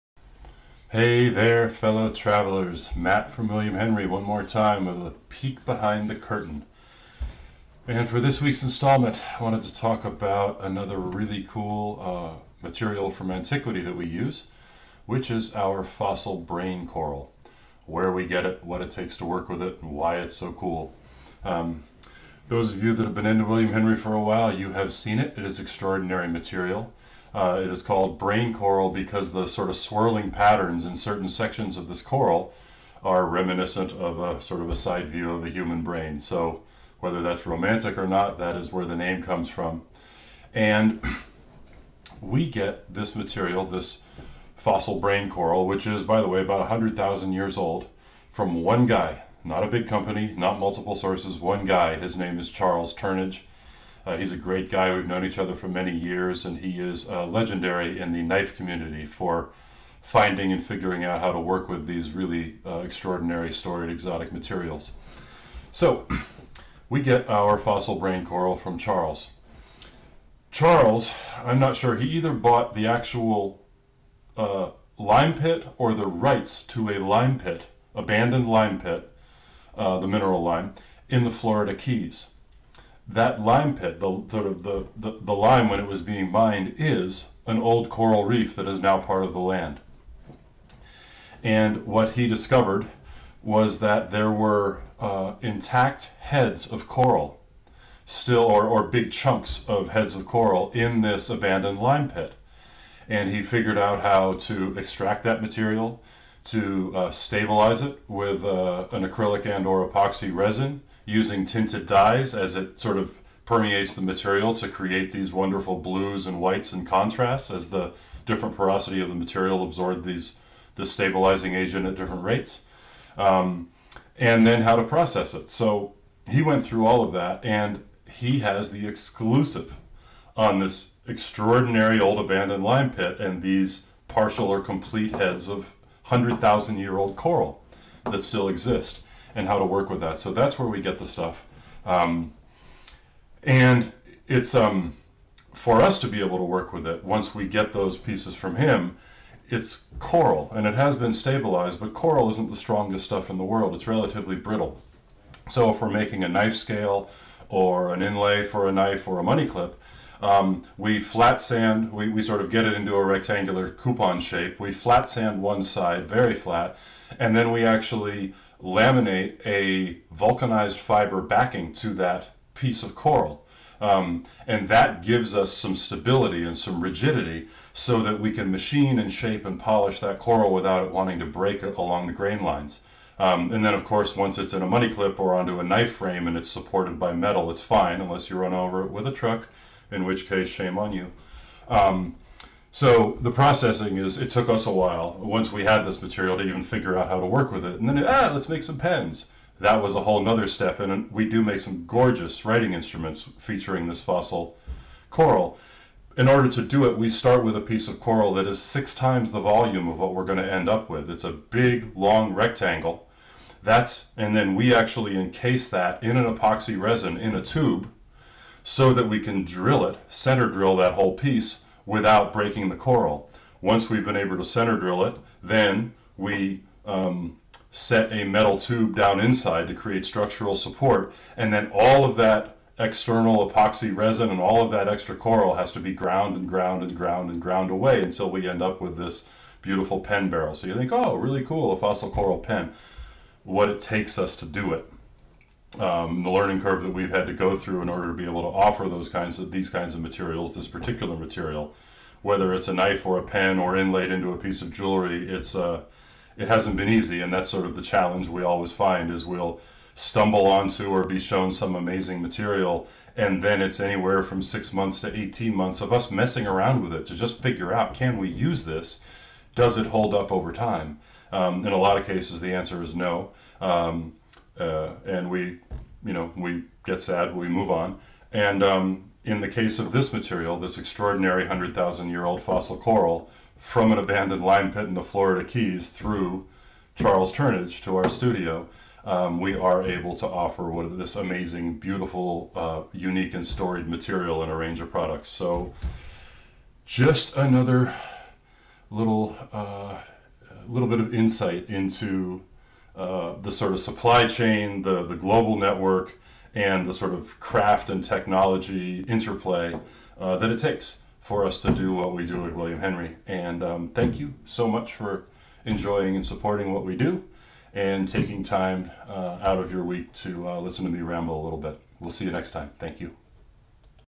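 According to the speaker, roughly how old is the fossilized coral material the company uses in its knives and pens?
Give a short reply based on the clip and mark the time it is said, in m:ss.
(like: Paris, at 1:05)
100,000 years, at 0:46.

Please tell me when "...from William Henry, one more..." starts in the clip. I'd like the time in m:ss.
0:03.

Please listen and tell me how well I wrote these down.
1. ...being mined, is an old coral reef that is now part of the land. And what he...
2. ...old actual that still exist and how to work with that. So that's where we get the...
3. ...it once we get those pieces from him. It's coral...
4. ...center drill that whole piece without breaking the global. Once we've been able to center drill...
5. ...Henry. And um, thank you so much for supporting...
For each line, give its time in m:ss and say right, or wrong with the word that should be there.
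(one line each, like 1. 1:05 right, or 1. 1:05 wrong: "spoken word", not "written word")
1. 1:26 right
2. 2:16 wrong: "coral", not "actual"
3. 2:26 right
4. 3:40 wrong: "coral", not "global"
5. 5:12 wrong: "enjoying", not "supporting".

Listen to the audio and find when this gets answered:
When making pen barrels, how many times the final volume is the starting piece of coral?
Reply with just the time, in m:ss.
3:28.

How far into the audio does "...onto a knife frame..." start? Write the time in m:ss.
3:05.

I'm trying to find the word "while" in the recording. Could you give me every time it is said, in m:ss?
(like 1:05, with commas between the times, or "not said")
0:24, 3:14.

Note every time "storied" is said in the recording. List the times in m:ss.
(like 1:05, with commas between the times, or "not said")
1:03, 4:53.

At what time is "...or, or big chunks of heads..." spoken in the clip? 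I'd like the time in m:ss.
1:38.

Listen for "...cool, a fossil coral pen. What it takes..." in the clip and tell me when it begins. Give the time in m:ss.
4:01.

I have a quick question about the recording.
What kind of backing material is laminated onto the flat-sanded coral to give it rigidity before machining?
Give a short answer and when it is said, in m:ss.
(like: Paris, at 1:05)
vulcanized fiber, at 2:50.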